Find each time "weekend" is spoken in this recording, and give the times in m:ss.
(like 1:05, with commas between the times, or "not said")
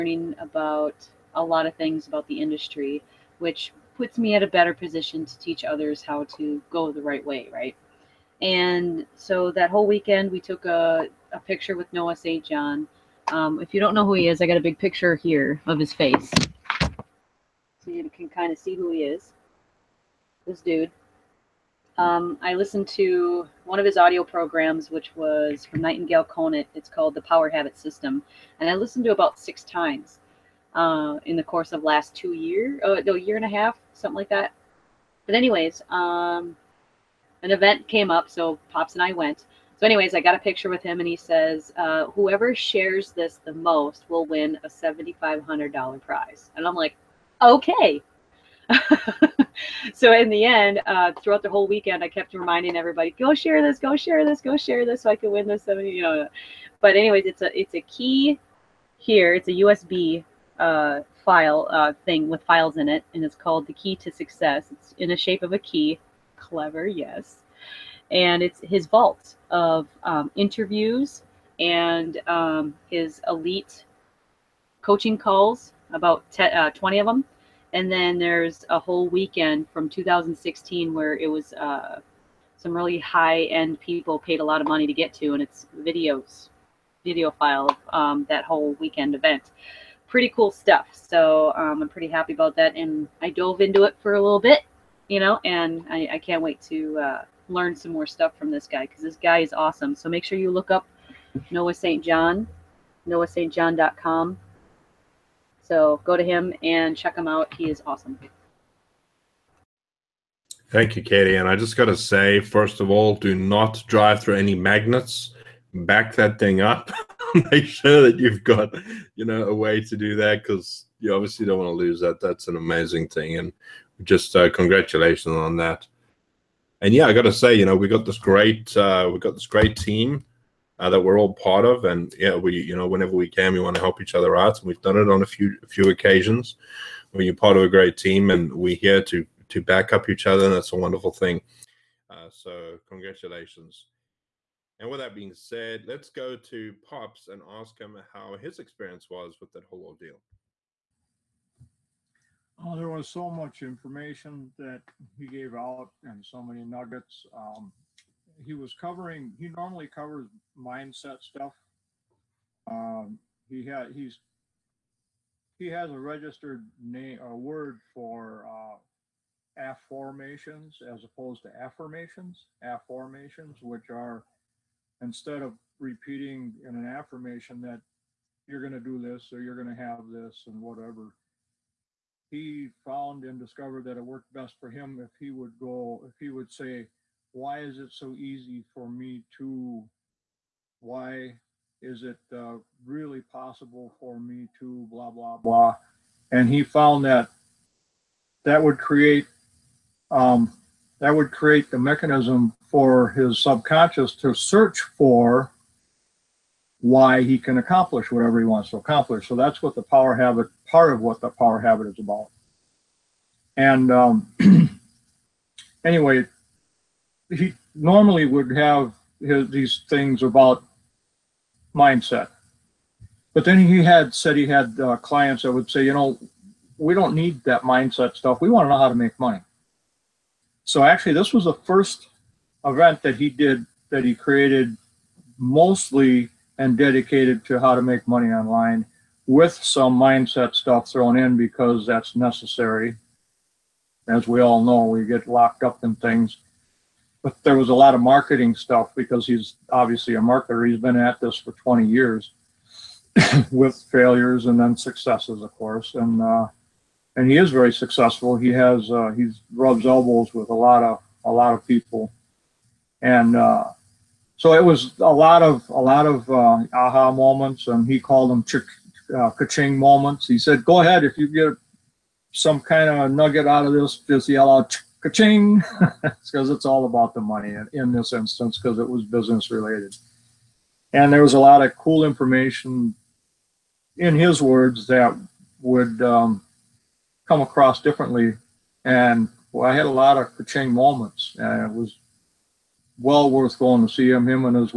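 0:09, 0:51, 1:19, 1:28.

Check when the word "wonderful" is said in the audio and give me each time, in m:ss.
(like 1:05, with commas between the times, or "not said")
2:20.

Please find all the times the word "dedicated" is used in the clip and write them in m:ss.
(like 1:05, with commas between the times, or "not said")
3:56.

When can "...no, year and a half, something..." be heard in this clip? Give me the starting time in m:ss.
0:33.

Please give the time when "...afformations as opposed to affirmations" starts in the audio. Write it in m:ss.
2:49.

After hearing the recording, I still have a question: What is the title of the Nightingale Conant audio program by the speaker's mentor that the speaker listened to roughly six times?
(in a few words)
The Power Habit System.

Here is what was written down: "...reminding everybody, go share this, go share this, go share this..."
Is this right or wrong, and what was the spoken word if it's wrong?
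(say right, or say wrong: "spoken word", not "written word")
right.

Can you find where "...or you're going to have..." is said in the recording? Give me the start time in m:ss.
2:59.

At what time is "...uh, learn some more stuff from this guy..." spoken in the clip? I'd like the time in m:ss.
1:36.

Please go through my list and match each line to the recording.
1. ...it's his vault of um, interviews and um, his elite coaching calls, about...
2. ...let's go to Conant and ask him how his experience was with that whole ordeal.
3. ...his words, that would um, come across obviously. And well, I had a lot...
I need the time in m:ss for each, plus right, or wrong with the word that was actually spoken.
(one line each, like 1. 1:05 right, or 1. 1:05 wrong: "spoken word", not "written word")
1. 1:08 right
2. 2:25 wrong: "Pops", not "Conant"
3. 4:44 wrong: "differently", not "obviously".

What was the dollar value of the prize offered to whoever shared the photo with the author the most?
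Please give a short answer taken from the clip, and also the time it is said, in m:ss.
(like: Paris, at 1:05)
$7,500, at 0:44.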